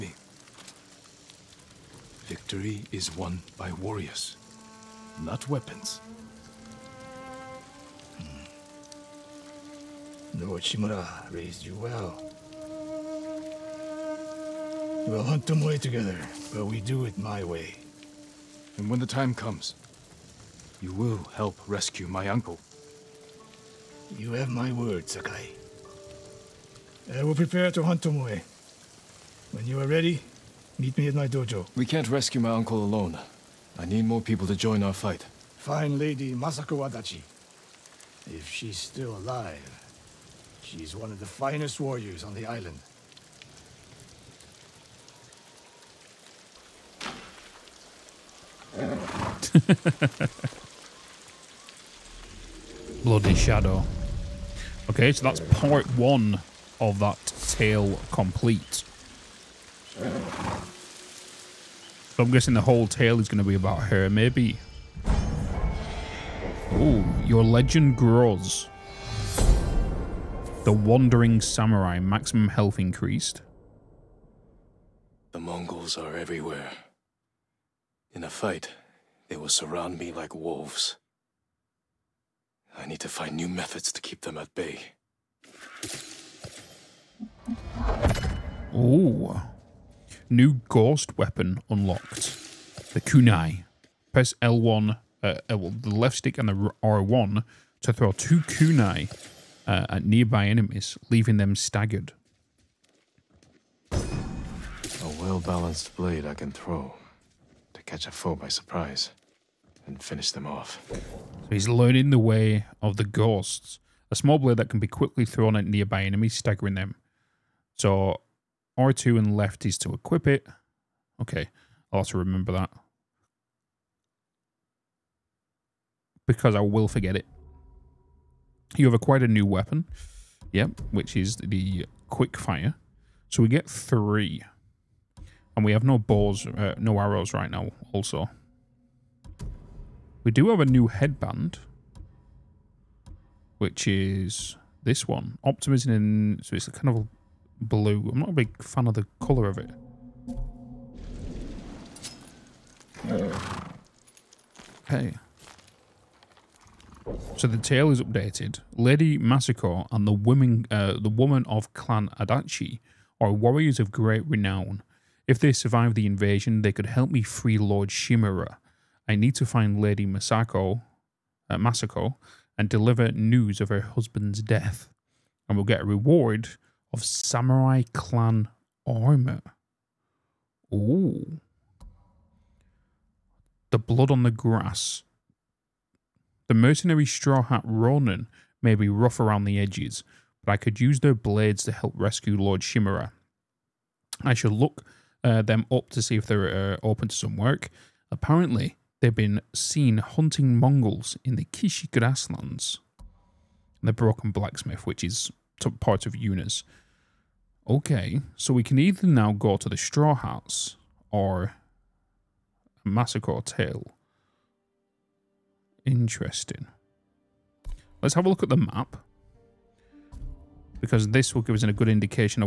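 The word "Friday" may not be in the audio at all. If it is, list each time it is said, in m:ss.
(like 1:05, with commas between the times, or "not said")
not said.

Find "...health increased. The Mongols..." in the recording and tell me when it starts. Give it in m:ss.
1:12.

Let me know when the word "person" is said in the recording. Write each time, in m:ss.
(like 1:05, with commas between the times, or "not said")
not said.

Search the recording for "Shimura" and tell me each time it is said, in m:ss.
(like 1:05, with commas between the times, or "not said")
0:10, 2:47, 3:12.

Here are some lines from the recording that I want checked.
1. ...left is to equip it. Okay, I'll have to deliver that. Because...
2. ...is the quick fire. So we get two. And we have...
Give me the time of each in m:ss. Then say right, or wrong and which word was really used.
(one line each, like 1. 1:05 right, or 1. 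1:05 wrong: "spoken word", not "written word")
1. 1:59 wrong: "remember", not "deliver"
2. 2:11 wrong: "three", not "two".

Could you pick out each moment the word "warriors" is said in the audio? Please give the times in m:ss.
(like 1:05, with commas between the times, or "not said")
0:03, 0:41, 2:43.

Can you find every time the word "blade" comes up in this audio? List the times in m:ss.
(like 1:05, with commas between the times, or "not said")
1:45, 1:54, 3:11.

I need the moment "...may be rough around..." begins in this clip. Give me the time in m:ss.
3:08.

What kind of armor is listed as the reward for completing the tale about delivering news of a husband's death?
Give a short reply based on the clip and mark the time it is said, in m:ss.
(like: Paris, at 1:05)
Samurai clan armor, at 2:57.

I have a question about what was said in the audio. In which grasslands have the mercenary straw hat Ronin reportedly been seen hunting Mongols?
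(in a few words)
Kishi grasslands.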